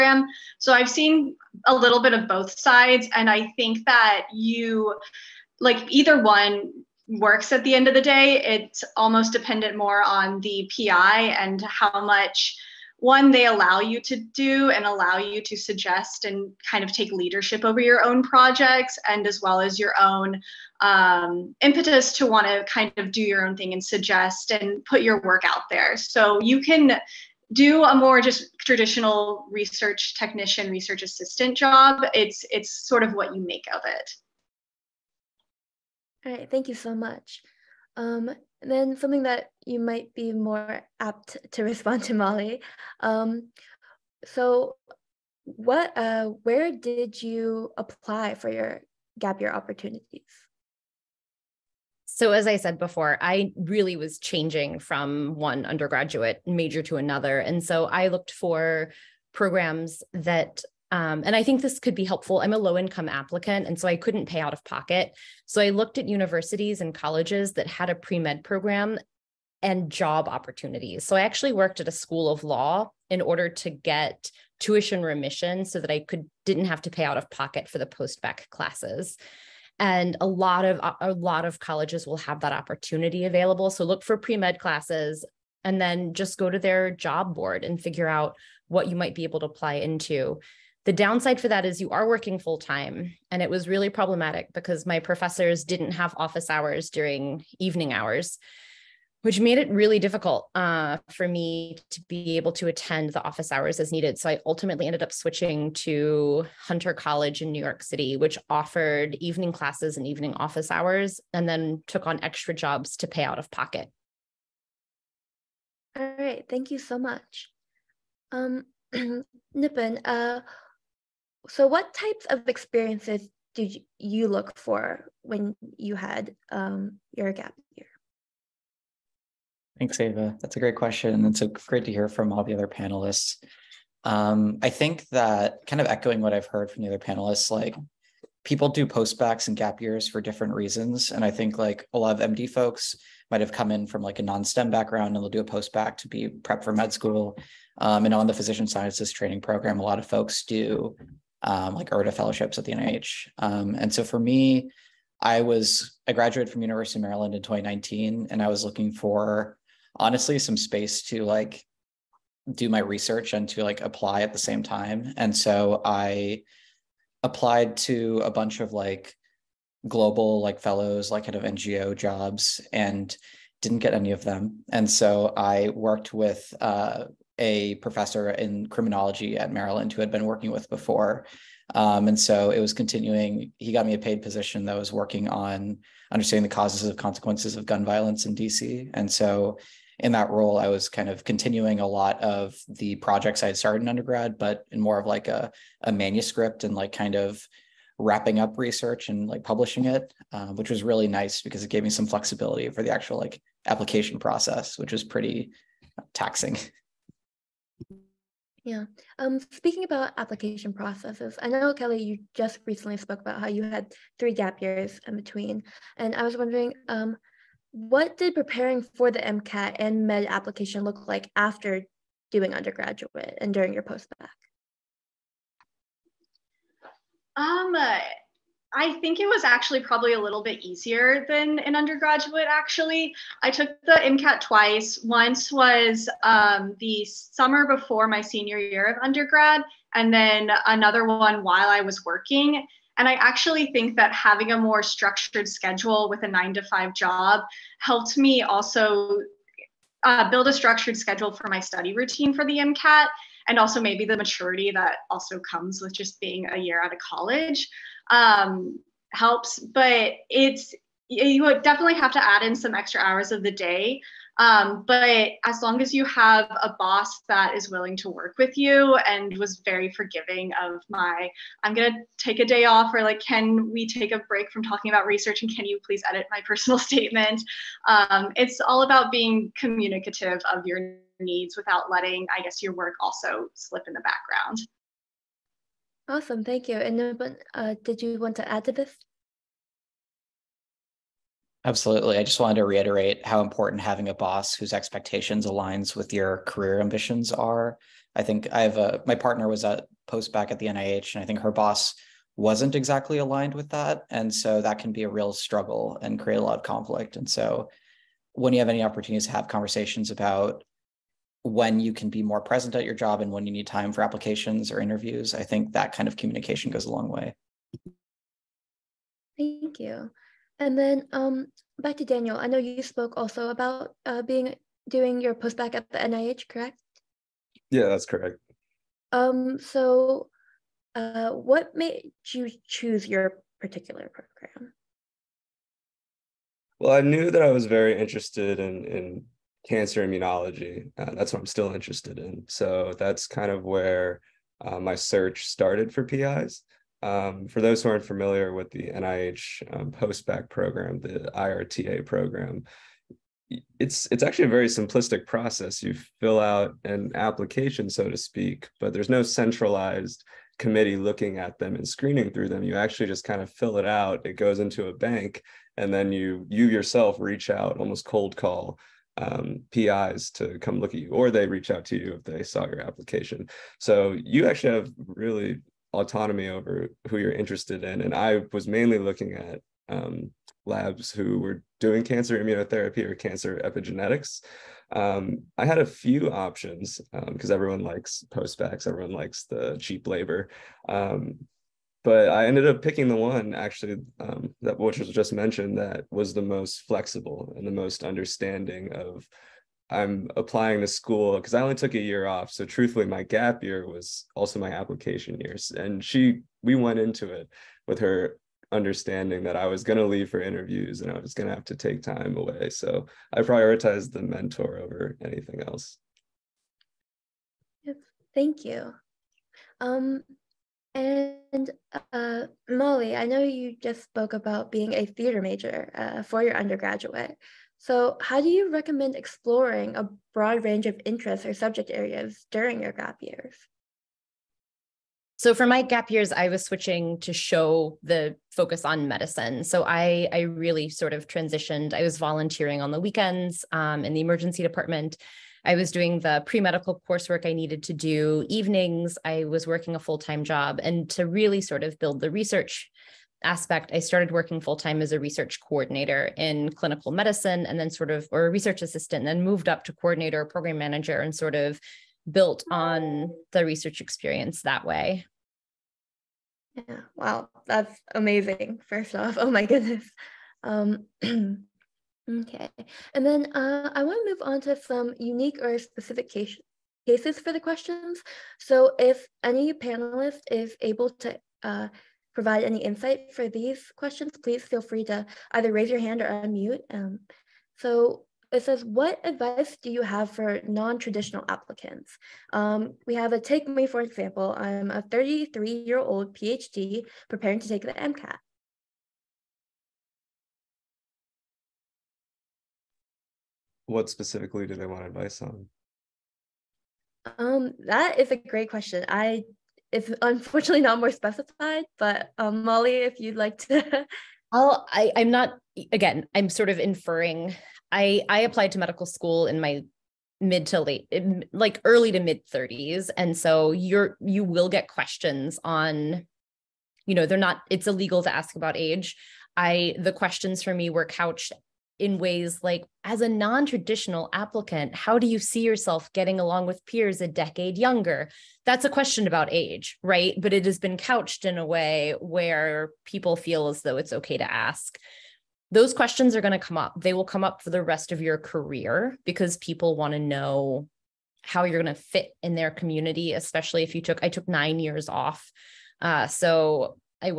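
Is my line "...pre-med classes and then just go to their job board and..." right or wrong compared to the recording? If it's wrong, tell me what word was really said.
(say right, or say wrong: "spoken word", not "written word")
right.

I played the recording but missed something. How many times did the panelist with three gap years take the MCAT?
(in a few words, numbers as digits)
twice.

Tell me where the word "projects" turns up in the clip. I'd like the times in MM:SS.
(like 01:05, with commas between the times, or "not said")
00:18, 03:12.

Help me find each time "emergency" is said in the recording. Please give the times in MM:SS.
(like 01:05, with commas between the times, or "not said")
07:24.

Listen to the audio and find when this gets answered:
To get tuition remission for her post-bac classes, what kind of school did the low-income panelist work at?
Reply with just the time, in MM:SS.
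01:11.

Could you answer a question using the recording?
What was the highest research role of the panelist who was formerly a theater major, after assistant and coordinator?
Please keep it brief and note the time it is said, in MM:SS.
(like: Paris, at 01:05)
program manager, at 07:40.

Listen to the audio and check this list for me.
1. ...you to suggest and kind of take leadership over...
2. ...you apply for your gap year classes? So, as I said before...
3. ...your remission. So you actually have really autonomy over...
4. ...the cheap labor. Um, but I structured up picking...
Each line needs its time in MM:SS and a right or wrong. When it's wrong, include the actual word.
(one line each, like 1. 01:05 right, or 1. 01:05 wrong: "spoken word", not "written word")
1. 00:15 right
2. 00:47 wrong: "opportunities", not "classes"
3. 06:12 wrong: "application", not "remission"
4. 06:29 wrong: "ended", not "structured".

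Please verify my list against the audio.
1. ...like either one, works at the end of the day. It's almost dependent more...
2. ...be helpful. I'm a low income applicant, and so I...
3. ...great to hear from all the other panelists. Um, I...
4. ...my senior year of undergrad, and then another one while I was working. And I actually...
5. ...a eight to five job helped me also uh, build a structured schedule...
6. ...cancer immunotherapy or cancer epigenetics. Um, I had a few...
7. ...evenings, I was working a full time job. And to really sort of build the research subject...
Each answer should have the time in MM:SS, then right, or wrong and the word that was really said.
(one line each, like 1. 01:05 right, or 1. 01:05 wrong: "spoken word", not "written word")
1. 00:05 right
2. 01:01 right
3. 02:11 right
4. 03:58 right
5. 04:06 wrong: "nine", not "eight"
6. 06:22 right
7. 07:28 wrong: "aspect", not "subject".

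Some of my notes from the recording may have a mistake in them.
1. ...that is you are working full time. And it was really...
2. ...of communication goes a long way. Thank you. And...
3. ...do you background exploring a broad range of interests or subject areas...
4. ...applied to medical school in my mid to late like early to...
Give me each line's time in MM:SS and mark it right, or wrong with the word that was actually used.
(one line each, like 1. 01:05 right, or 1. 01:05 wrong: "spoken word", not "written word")
1. 01:31 right
2. 05:16 right
3. 07:08 wrong: "recommend", not "background"
4. 08:38 right.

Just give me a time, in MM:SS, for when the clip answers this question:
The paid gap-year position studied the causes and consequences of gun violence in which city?
03:08.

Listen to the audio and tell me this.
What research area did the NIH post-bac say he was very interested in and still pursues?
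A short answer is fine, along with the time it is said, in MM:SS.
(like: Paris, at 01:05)
cancer immunology, at 05:39.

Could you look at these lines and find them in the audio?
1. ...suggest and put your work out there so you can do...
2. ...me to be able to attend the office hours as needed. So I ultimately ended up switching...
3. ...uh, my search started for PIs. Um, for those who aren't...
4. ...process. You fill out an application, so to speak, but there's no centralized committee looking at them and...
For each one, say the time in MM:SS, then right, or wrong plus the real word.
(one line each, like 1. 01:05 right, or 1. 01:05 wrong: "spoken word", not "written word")
1. 00:23 right
2. 01:41 right
3. 05:44 right
4. 05:55 right.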